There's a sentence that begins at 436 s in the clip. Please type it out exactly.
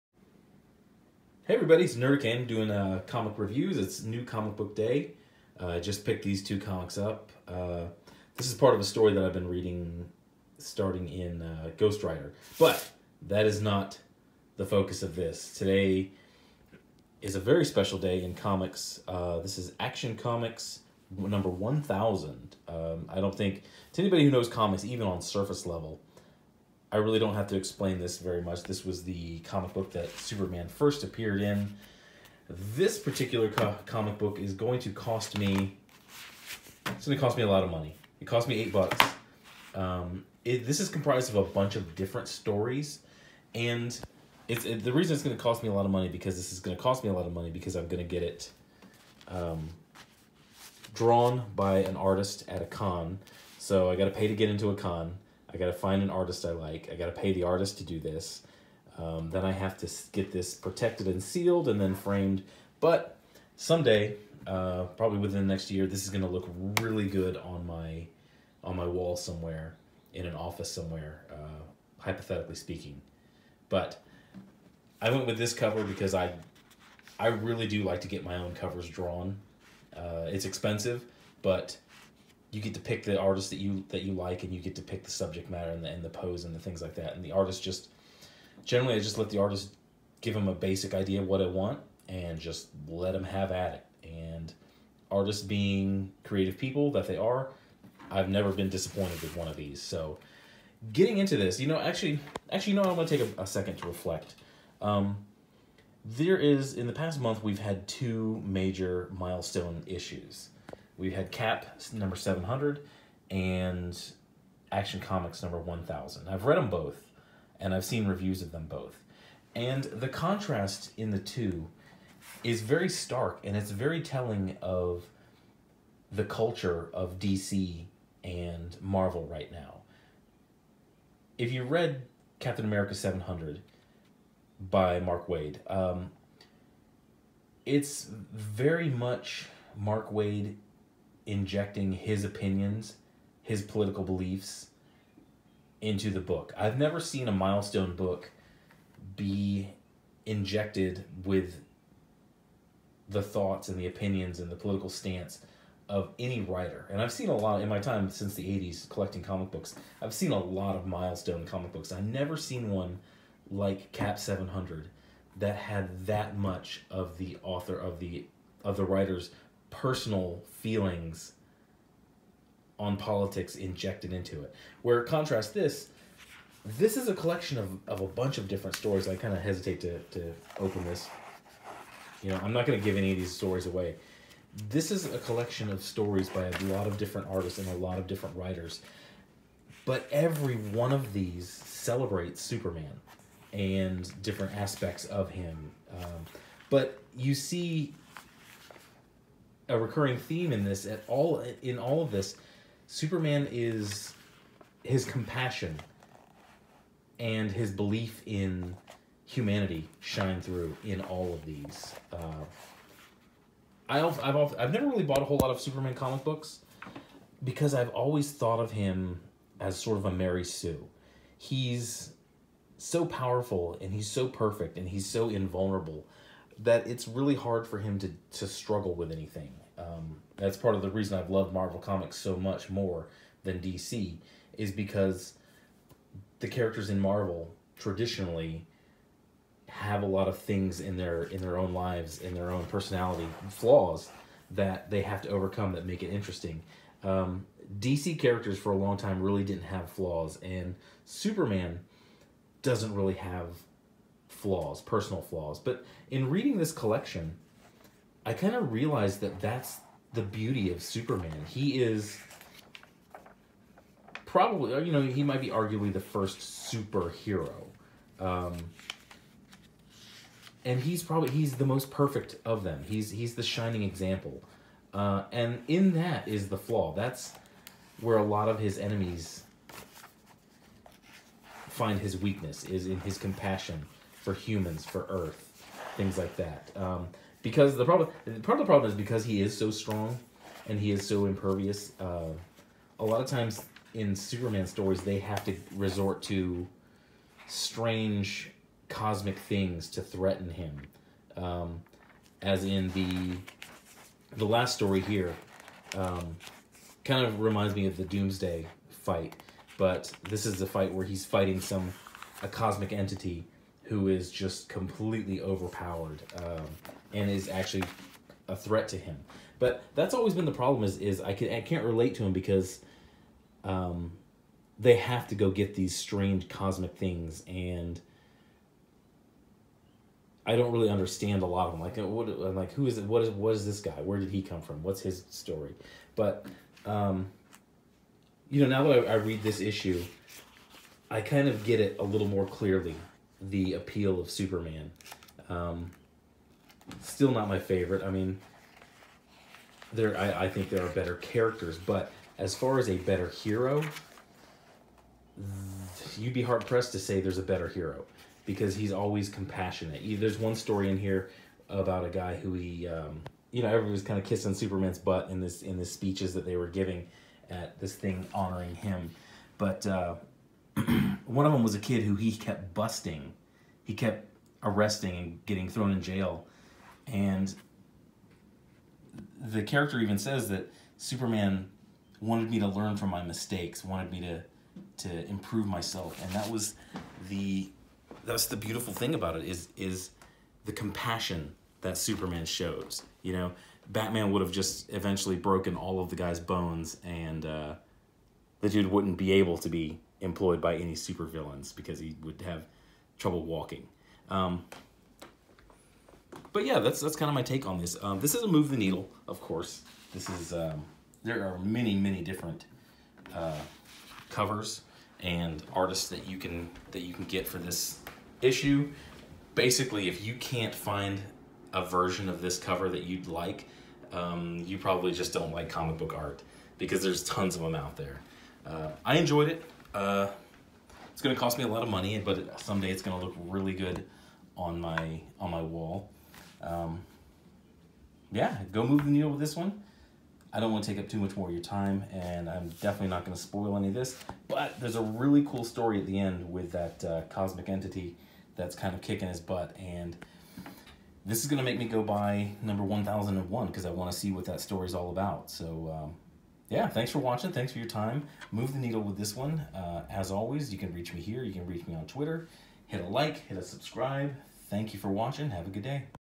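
Um, yeah, go move the needle with this one.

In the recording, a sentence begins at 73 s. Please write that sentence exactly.
But I went with this cover because I I really do like to get my own covers drawn.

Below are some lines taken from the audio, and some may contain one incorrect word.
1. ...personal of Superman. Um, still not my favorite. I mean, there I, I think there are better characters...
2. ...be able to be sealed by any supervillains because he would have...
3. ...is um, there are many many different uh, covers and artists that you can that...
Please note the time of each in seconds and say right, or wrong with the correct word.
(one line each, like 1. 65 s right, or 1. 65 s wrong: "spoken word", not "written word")
1. 343 s wrong: "appeal", not "personal"
2. 399 s wrong: "employed", not "sealed"
3. 410 s right.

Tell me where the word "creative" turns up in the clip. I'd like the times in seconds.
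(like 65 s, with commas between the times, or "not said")
96 s.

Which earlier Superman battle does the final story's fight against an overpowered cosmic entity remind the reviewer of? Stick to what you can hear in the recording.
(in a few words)
Doomsday fight.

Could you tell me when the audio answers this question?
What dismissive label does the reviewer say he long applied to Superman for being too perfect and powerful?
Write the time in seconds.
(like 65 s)
220 s.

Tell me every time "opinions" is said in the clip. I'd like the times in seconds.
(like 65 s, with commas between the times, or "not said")
142 s, 153 s.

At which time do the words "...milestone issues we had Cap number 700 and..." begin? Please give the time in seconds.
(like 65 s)
109 s.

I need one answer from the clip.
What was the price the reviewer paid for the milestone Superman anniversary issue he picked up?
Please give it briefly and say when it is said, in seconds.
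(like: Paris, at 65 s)
$8, at 38 s.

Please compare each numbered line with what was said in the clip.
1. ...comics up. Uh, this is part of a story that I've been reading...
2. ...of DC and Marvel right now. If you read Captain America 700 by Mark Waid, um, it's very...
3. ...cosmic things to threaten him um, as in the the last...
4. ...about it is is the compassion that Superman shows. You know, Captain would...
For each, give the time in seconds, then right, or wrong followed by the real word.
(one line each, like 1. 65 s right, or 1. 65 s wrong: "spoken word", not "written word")
1. 6 s right
2. 126 s right
3. 298 s right
4. 389 s wrong: "Batman", not "Captain".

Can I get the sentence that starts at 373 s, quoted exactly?
He kept arresting and getting thrown in jail.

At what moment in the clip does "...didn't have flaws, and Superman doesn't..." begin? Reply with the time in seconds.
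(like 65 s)
249 s.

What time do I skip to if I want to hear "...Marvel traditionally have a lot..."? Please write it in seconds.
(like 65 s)
236 s.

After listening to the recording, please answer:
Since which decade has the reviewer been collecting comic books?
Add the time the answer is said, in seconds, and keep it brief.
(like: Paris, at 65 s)
the 80s, at 158 s.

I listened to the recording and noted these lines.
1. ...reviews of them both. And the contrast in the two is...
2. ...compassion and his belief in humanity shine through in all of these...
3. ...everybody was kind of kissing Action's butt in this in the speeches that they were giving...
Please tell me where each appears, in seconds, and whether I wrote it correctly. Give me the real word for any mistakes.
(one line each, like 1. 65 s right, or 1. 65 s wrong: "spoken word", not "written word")
1. 118 s right
2. 205 s right
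3. 363 s wrong: "Superman", not "Action".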